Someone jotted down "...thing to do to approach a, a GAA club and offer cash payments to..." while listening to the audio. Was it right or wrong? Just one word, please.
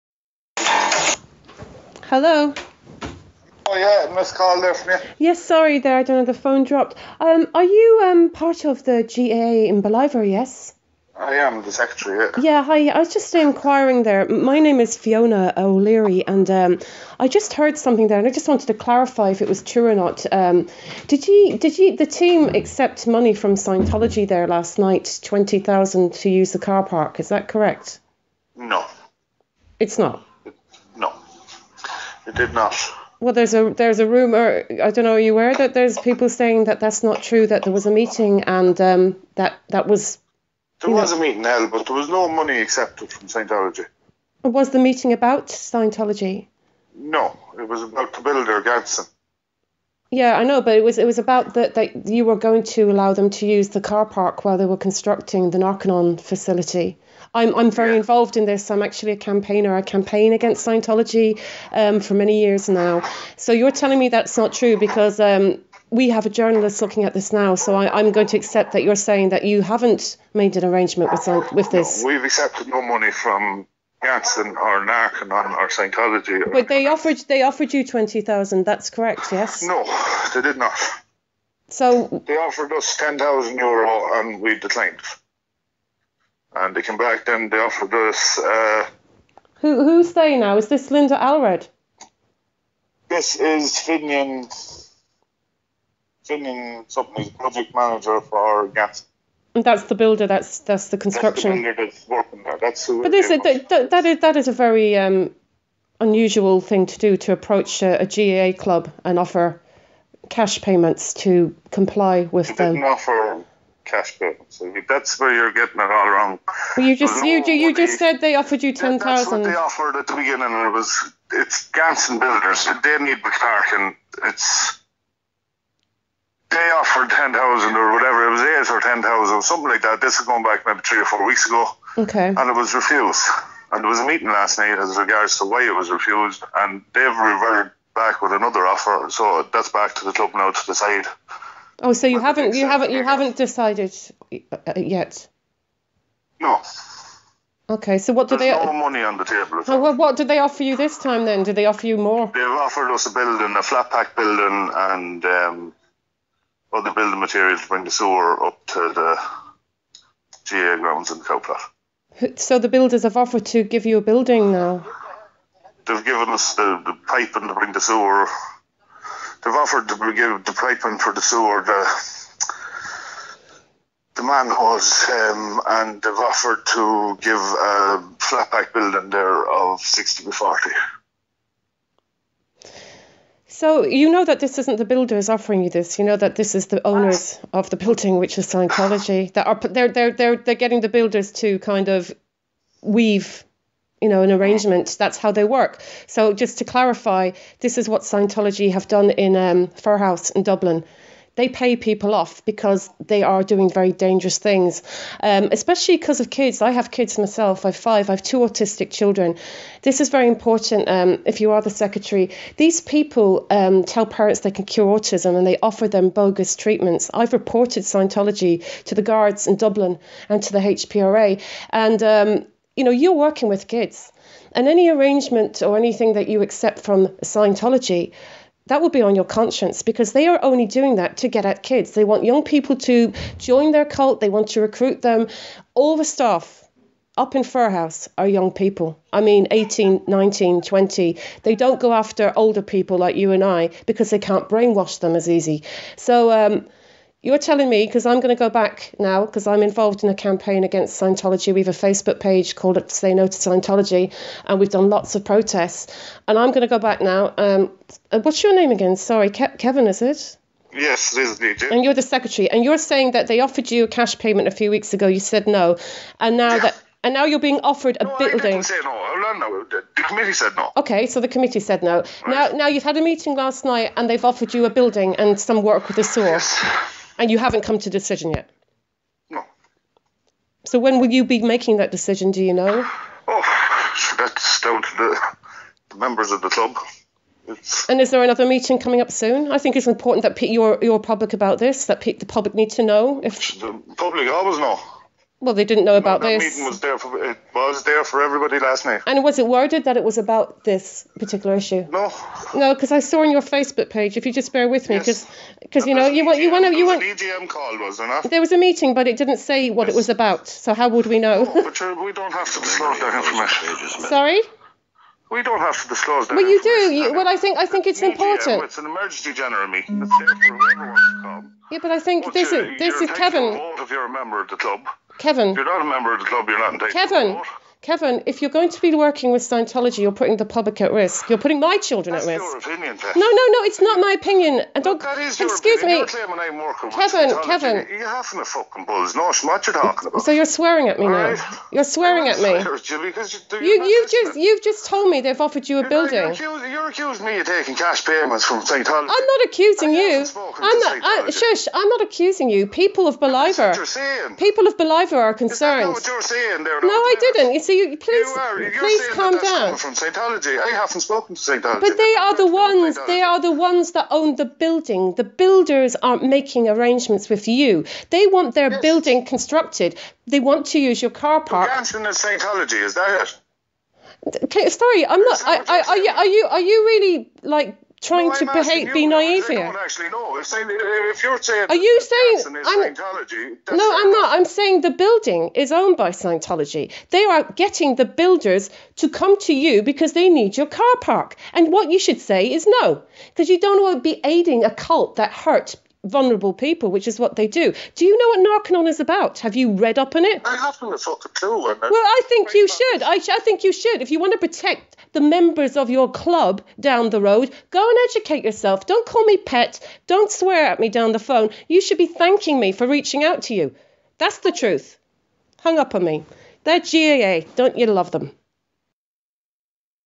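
right.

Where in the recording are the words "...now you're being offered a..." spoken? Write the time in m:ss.
4:27.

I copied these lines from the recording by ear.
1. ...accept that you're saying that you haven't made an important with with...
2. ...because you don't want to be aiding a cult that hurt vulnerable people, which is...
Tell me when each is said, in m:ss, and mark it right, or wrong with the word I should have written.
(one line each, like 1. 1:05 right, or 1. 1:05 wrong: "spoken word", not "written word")
1. 1:08 wrong: "arrangement", not "important"
2. 6:33 right.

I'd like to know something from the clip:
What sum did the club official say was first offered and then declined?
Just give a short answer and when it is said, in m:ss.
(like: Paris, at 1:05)
10,000 euro, at 1:22.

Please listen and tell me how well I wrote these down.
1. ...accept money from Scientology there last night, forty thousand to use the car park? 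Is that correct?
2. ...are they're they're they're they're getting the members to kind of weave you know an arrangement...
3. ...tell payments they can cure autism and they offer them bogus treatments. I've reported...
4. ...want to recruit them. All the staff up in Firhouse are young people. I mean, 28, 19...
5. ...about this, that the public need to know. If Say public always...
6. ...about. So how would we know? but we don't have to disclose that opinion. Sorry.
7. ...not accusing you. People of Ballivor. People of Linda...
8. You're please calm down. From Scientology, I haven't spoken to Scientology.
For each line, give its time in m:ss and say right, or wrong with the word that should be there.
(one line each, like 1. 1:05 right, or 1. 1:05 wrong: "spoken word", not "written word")
1. 0:22 wrong: "twenty", not "forty"
2. 3:09 wrong: "builders", not "members"
3. 3:33 wrong: "parents", not "payments"
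4. 3:54 wrong: "18", not "28"
5. 4:51 wrong: "The", not "Say"
6. 5:10 wrong: "information", not "opinion"
7. 5:51 wrong: "Ballivor", not "Linda"
8. 5:58 right.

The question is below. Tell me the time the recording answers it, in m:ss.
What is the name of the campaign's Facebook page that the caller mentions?
4:12.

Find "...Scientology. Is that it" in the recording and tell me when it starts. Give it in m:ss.
6:11.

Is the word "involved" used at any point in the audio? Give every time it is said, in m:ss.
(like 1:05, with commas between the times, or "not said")
0:57, 4:09.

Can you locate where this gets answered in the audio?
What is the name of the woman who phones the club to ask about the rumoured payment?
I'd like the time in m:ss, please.
0:14.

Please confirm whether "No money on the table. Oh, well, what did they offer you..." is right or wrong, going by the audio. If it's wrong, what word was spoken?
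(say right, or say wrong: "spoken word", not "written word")
right.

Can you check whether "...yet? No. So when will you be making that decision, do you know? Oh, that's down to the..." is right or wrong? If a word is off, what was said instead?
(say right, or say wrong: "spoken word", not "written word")
right.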